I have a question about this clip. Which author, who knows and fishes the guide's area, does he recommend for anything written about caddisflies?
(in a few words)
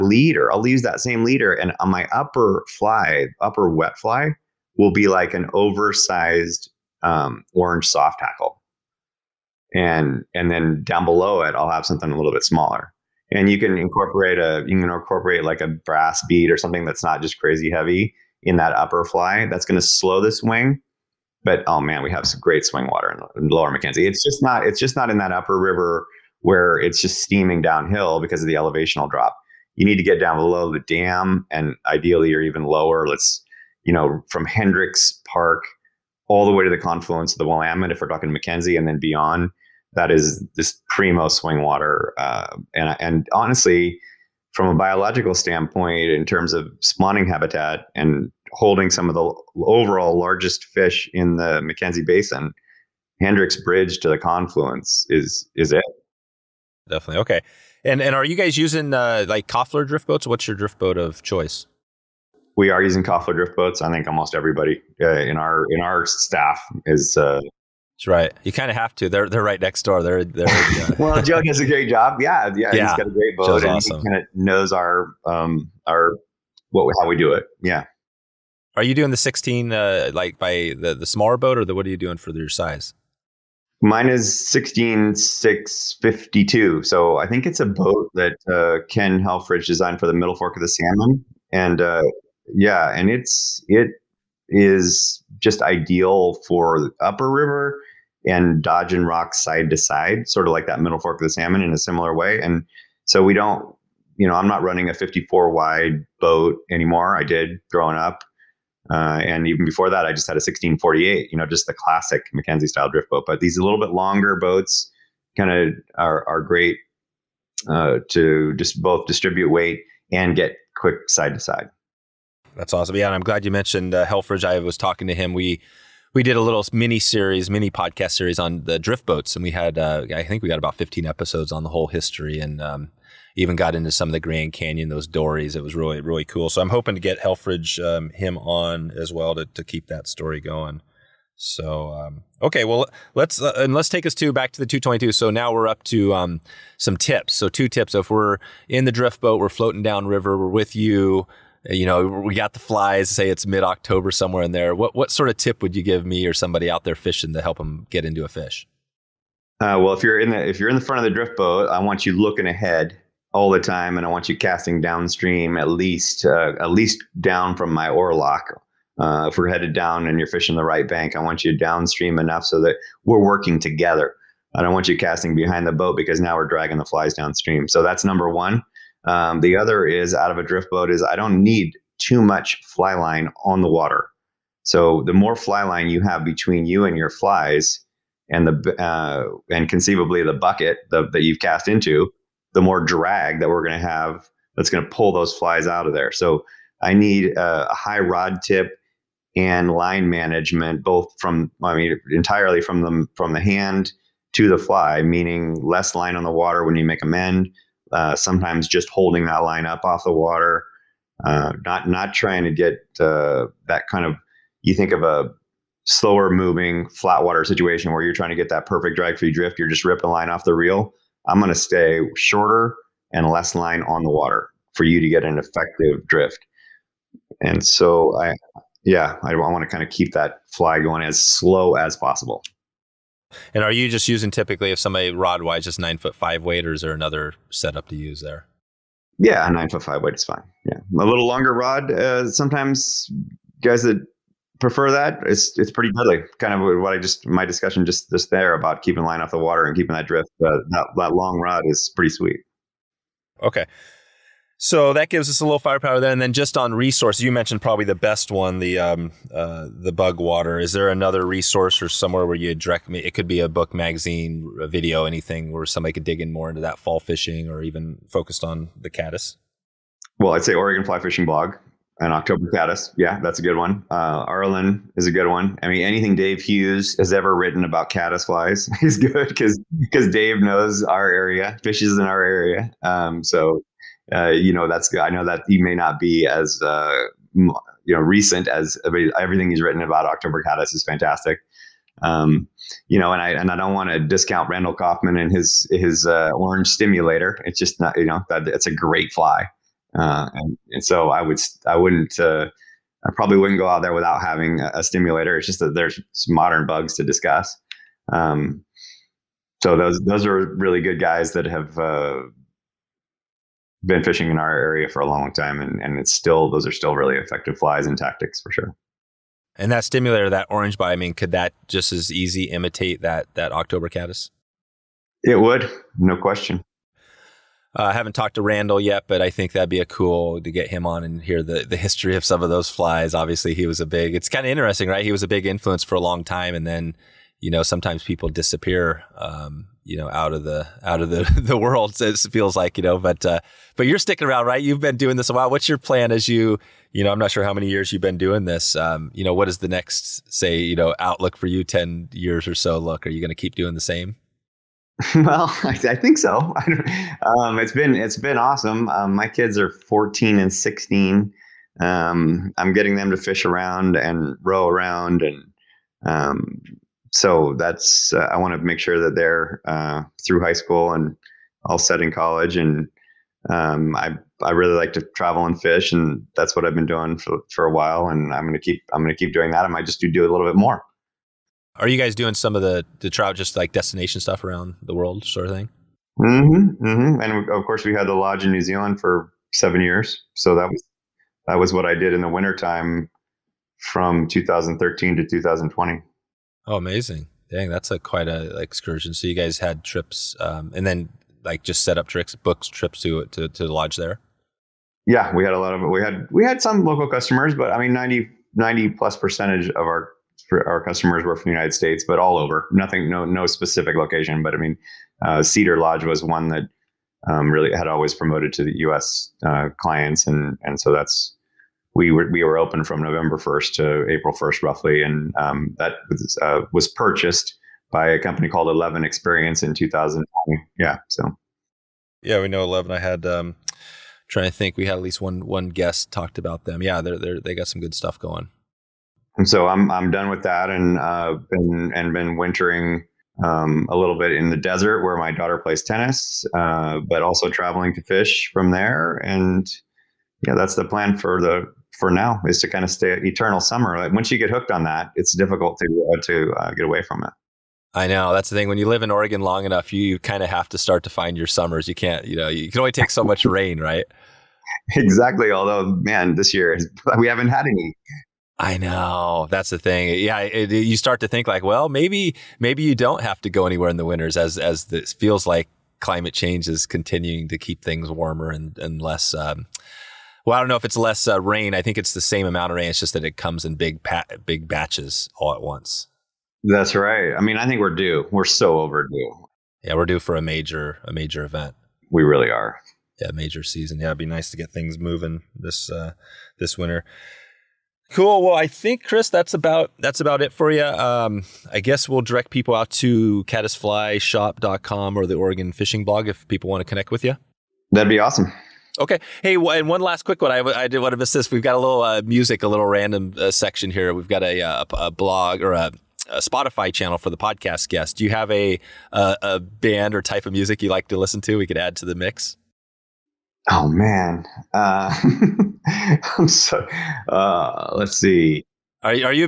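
Dave Hughes.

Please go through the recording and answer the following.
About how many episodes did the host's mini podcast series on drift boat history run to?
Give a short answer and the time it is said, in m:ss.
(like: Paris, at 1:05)
15, at 2:10.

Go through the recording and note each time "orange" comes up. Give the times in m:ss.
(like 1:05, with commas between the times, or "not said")
0:07, 4:56, 5:20.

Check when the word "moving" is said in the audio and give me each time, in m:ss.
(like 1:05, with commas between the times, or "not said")
3:36, 8:14.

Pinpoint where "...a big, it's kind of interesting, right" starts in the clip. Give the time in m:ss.
5:33.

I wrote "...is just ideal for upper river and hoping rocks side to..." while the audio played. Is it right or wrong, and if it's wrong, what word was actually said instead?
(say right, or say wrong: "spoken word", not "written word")
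wrong: "dodging", not "hoping".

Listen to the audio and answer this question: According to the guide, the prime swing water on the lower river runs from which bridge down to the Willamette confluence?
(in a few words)
Hendricks Bridge.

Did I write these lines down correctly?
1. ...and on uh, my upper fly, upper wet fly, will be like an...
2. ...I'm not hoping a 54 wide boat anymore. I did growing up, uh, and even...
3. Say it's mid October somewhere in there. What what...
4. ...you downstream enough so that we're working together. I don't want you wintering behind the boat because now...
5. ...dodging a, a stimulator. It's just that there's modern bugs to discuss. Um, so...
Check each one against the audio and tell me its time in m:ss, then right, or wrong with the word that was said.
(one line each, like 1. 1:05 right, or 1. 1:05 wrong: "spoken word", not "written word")
1. 0:01 right
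2. 1:44 wrong: "running", not "hoping"
3. 2:33 right
4. 2:51 wrong: "casting", not "wintering"
5. 5:04 wrong: "having", not "dodging".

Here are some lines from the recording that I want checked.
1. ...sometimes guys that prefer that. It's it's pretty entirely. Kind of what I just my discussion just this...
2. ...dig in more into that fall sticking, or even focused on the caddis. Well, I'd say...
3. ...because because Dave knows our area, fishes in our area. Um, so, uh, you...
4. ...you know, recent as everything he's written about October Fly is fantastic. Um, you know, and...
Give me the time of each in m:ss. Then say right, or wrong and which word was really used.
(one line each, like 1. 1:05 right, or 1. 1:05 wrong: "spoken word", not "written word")
1. 4:02 wrong: "deadly", not "entirely"
2. 4:26 wrong: "fishing", not "sticking"
3. 4:39 right
4. 4:47 wrong: "Caddis", not "Fly".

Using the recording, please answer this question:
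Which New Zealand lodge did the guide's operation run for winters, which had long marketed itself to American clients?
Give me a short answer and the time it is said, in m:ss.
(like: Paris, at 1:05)
Cedar Lodge, at 6:55.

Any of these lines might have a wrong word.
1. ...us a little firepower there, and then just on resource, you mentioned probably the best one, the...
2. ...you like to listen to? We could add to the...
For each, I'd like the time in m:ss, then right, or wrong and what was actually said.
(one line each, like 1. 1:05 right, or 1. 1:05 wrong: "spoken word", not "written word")
1. 4:15 right
2. 8:40 right.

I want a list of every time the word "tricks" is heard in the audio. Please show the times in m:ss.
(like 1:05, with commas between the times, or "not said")
6:42.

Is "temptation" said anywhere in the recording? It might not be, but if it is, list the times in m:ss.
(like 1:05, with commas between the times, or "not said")
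not said.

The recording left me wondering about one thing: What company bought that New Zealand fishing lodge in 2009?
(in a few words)
Eleven Experience.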